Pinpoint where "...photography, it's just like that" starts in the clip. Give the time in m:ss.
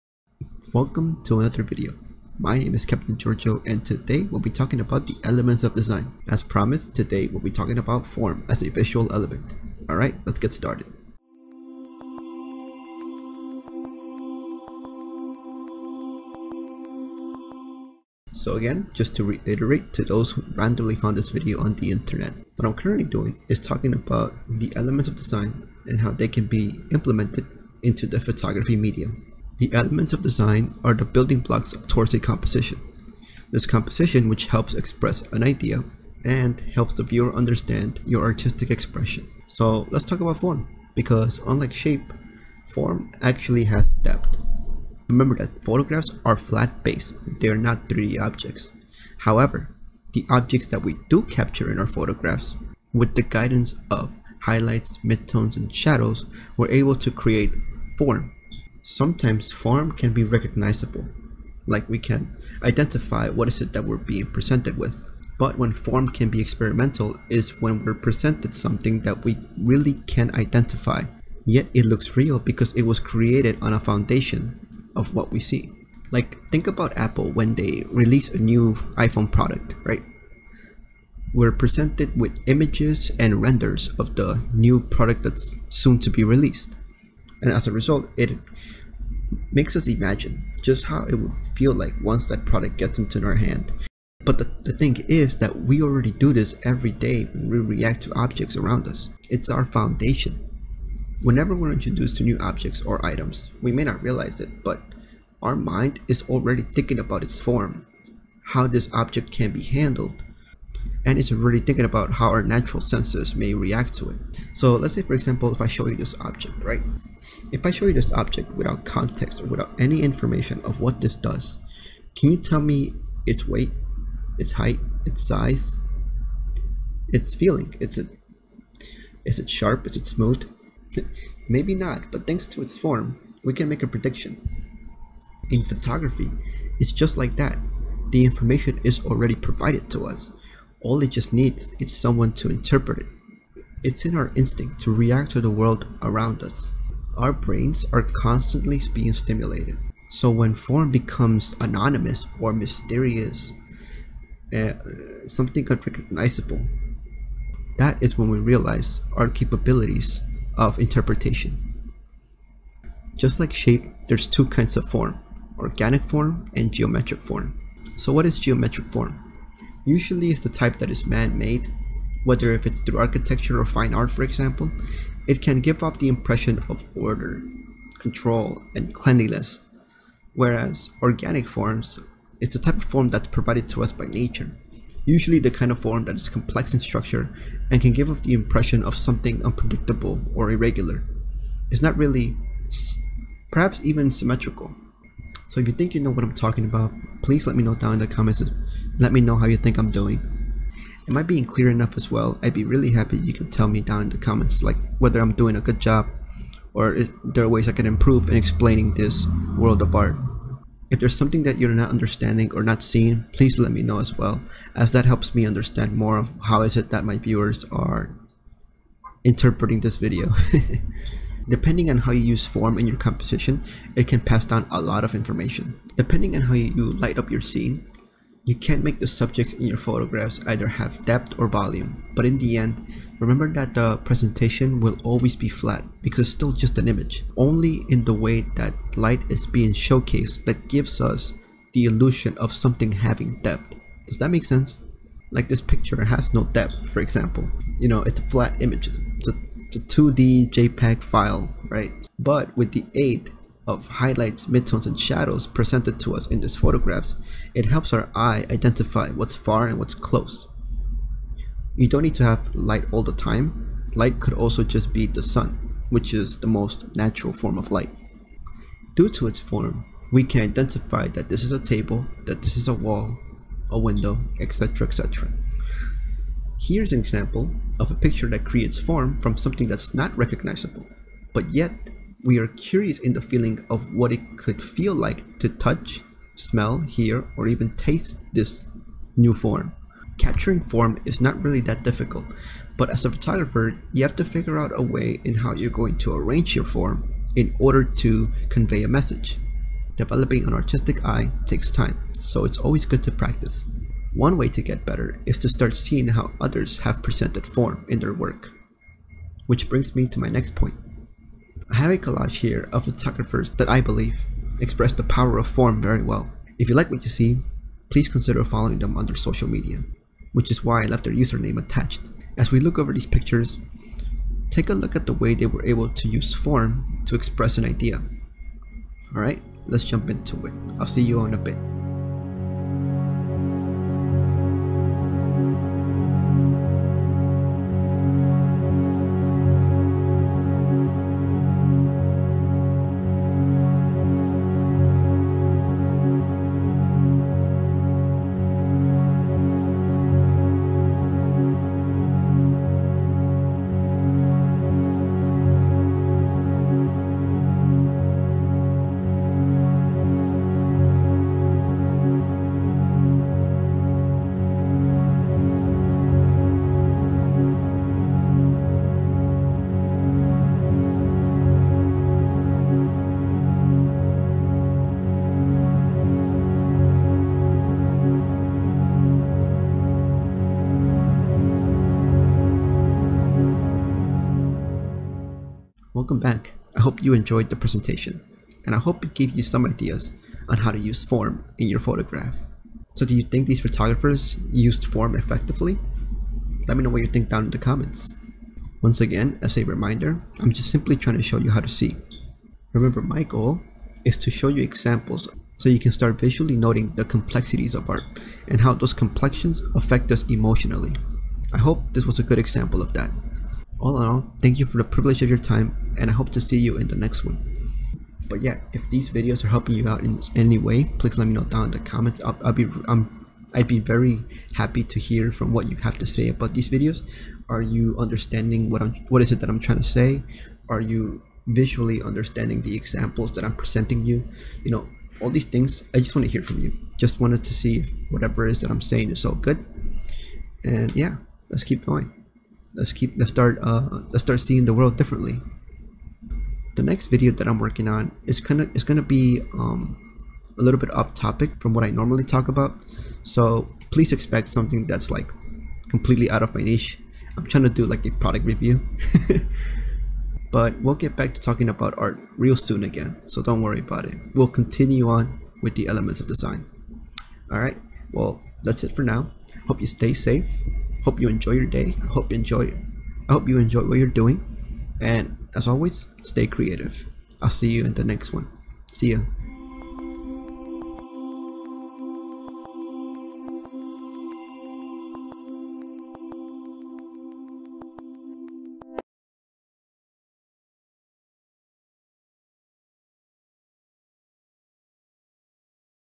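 2:15.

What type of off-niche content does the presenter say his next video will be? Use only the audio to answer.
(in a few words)
A product review.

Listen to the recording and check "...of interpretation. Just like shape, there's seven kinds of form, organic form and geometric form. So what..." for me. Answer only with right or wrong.
wrong.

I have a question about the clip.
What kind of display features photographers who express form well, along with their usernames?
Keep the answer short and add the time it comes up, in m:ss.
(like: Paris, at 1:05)
A collage, at 5:11.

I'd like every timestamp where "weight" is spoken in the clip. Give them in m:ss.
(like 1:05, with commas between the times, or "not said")
2:03.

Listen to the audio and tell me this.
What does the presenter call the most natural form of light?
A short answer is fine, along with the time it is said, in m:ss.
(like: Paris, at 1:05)
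The sun, at 4:25.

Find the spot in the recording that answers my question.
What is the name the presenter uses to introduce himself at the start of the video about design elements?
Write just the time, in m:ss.
0:02.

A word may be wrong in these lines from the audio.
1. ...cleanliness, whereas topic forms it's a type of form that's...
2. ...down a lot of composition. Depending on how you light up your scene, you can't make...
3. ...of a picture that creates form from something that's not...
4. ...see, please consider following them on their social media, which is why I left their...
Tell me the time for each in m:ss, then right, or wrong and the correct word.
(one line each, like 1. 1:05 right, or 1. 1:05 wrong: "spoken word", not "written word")
1. 2:58 wrong: "organic", not "topic"
2. 3:44 wrong: "information", not "composition"
3. 4:37 right
4. 5:17 right.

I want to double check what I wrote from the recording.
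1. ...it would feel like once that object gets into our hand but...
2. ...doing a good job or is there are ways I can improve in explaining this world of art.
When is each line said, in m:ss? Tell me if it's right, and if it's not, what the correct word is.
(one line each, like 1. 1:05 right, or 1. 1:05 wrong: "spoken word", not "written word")
1. 1:31 wrong: "product", not "object"
2. 3:25 right.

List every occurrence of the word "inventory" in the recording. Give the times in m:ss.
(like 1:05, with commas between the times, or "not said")
not said.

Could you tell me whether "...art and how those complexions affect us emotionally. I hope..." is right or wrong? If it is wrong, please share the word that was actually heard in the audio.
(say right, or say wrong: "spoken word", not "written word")
right.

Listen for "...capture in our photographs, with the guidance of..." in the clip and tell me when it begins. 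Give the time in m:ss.
0:51.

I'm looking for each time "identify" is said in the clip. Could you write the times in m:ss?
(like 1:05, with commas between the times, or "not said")
1:02, 1:10, 4:18, 4:30.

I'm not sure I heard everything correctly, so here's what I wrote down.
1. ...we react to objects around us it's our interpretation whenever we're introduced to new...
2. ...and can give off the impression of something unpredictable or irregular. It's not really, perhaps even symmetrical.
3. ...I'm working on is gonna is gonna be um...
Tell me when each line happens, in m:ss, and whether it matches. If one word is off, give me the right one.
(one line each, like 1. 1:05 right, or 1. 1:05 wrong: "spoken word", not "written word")
1. 1:37 wrong: "foundation", not "interpretation"
2. 3:07 right
3. 7:27 right.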